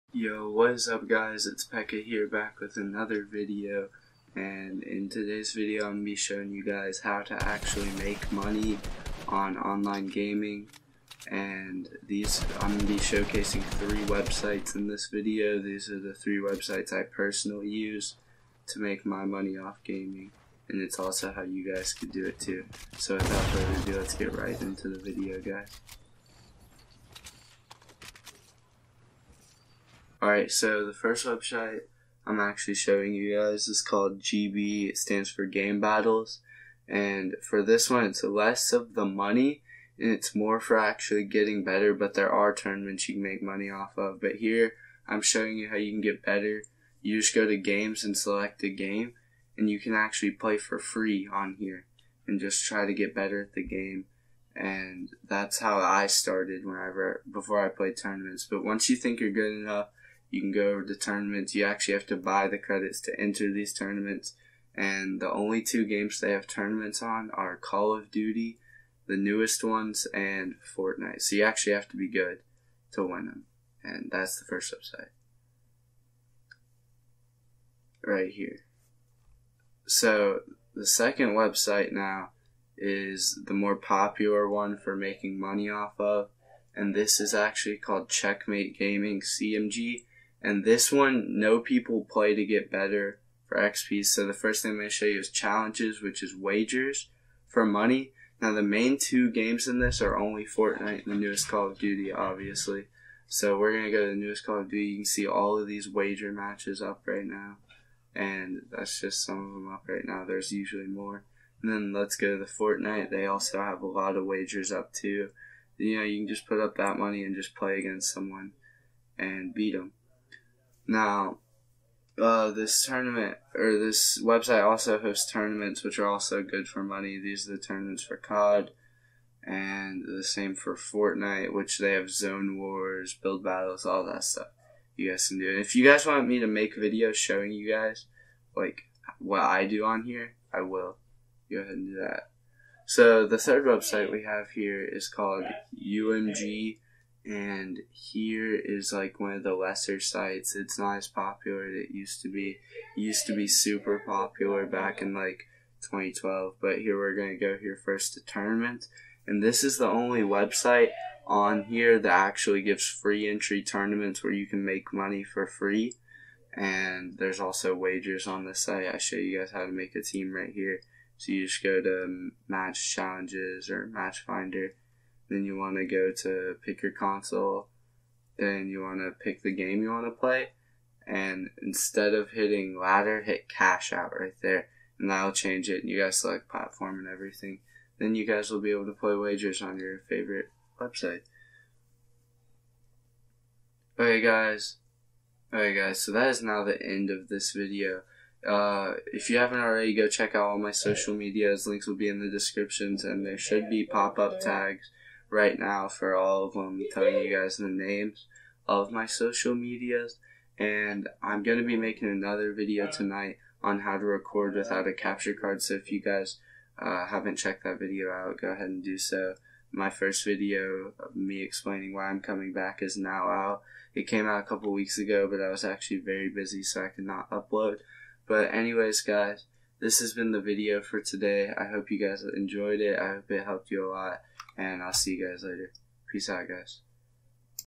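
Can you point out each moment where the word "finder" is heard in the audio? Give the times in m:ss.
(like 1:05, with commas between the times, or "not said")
2:54.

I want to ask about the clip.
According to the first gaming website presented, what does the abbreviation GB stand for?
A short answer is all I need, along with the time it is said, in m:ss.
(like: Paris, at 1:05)
Game Battles, at 0:35.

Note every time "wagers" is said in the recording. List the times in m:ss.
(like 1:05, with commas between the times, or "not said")
1:36, 1:45, 1:54, 2:47, 3:09.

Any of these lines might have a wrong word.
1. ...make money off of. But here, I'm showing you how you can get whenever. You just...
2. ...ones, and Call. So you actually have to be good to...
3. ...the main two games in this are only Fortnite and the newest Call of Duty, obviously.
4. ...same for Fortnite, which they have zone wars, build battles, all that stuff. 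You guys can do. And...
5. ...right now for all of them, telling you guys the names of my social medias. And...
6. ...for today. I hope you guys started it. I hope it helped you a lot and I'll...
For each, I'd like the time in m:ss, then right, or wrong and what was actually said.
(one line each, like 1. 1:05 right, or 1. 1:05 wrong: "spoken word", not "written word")
1. 0:43 wrong: "better", not "whenever"
2. 1:09 wrong: "Fortnite", not "Call"
3. 1:38 right
4. 2:10 right
5. 3:25 right
6. 3:50 wrong: "enjoyed", not "started".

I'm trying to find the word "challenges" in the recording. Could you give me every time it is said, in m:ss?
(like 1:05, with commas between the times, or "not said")
1:35, 2:52.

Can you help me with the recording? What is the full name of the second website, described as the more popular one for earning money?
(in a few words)
Checkmate Gaming.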